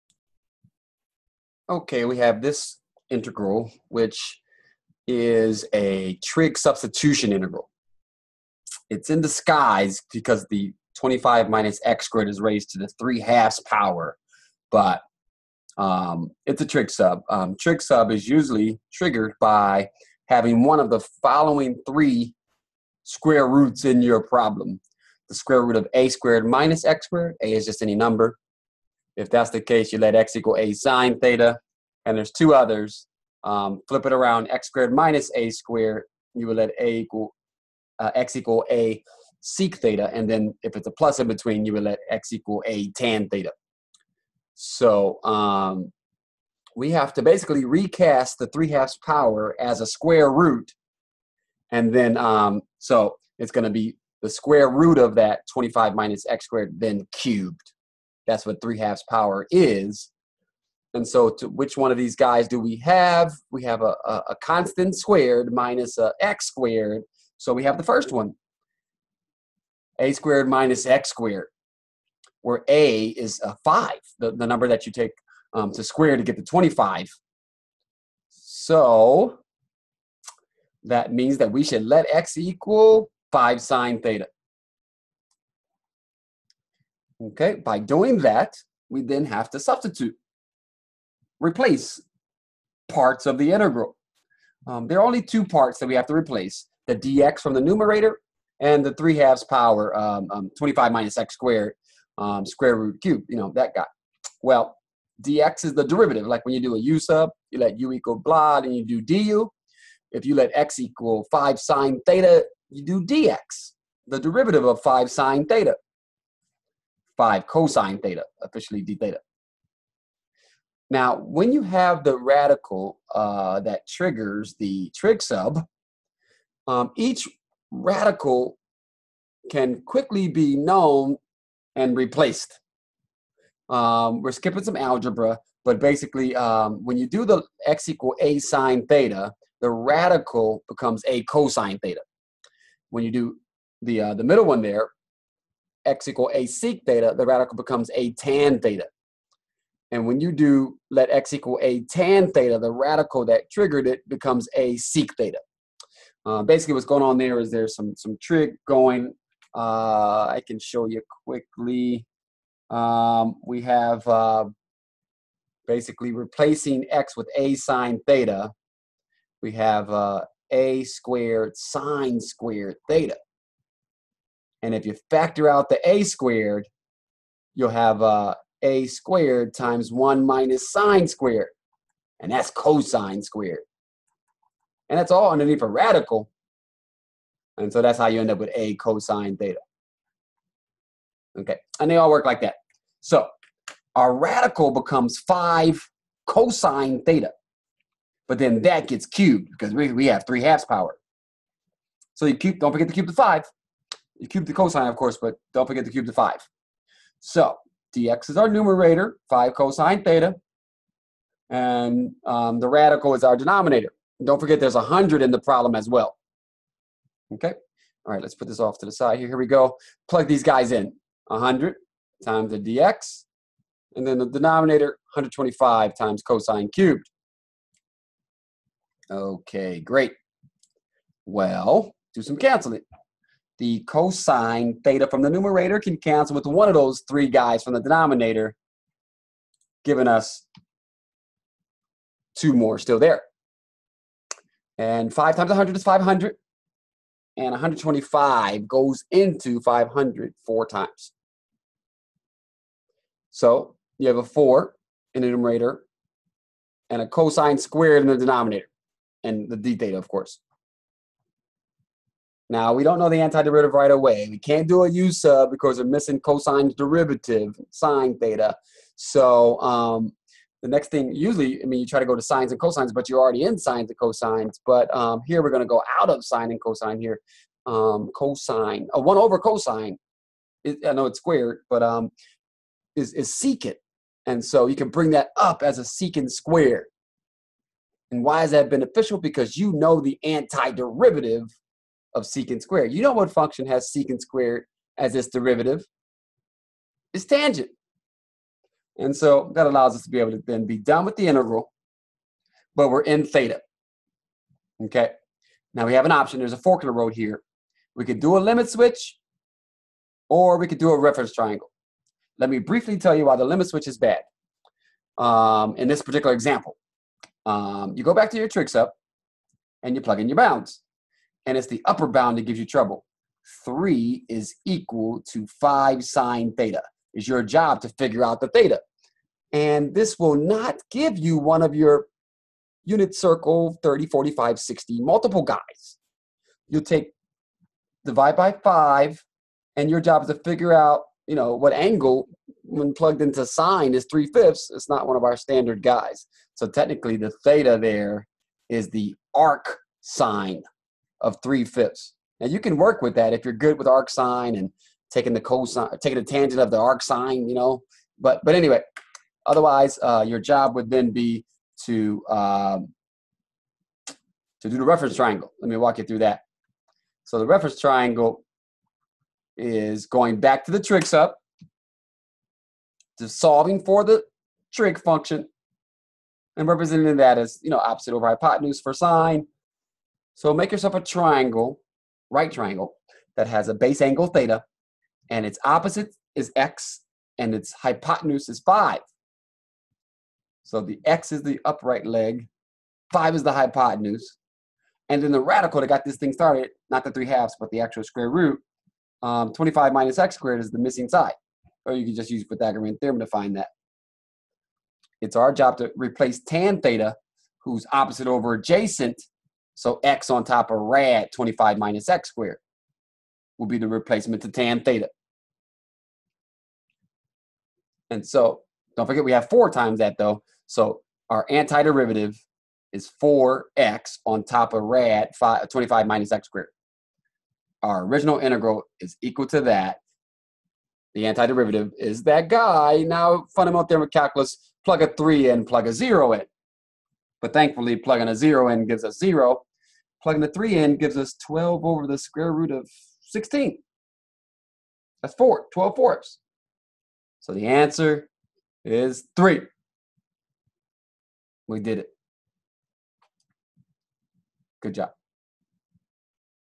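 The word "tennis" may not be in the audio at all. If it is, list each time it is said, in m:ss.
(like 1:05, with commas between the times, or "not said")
not said.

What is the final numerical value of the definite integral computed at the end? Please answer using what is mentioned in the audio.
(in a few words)
3.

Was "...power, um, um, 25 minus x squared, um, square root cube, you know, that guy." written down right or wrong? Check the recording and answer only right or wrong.
right.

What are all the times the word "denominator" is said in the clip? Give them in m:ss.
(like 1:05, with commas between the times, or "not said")
3:33, 3:44, 3:57, 4:18.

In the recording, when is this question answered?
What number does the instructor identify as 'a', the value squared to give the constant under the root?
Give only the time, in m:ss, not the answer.
1:12.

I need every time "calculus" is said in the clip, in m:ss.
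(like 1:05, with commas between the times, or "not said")
7:14.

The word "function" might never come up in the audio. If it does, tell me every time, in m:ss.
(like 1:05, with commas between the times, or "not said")
4:53, 6:15.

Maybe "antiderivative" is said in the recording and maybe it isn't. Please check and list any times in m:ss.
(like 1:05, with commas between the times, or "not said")
4:23, 4:50, 7:01, 7:11.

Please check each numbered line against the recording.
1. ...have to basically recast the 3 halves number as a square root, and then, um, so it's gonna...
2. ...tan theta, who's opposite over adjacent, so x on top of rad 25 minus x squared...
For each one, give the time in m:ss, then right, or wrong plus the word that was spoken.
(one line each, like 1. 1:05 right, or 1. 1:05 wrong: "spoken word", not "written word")
1. 0:46 wrong: "power", not "number"
2. 6:46 right.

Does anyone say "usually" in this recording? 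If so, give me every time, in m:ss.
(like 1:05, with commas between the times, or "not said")
0:18, 4:31.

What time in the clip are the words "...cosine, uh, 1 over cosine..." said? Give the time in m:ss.
4:38.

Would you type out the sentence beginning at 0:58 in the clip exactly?
That's what three halves power is.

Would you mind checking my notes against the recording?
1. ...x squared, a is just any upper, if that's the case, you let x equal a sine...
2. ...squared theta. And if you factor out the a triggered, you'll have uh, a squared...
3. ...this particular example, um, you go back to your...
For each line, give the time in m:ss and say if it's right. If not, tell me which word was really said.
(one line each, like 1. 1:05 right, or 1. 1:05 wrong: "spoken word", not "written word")
1. 0:26 wrong: "number", not "upper"
2. 2:52 wrong: "squared", not "triggered"
3. 5:15 right.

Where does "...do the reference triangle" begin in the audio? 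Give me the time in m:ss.
6:04.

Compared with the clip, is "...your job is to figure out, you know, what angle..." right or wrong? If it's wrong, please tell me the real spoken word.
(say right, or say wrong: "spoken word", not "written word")
right.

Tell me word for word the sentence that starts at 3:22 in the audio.
So you cube, don't forget to cube the 5 cube the cosine, of course, but don't forget to cube the 5.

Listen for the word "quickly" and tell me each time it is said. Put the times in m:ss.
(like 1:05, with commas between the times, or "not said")
2:09, 2:41.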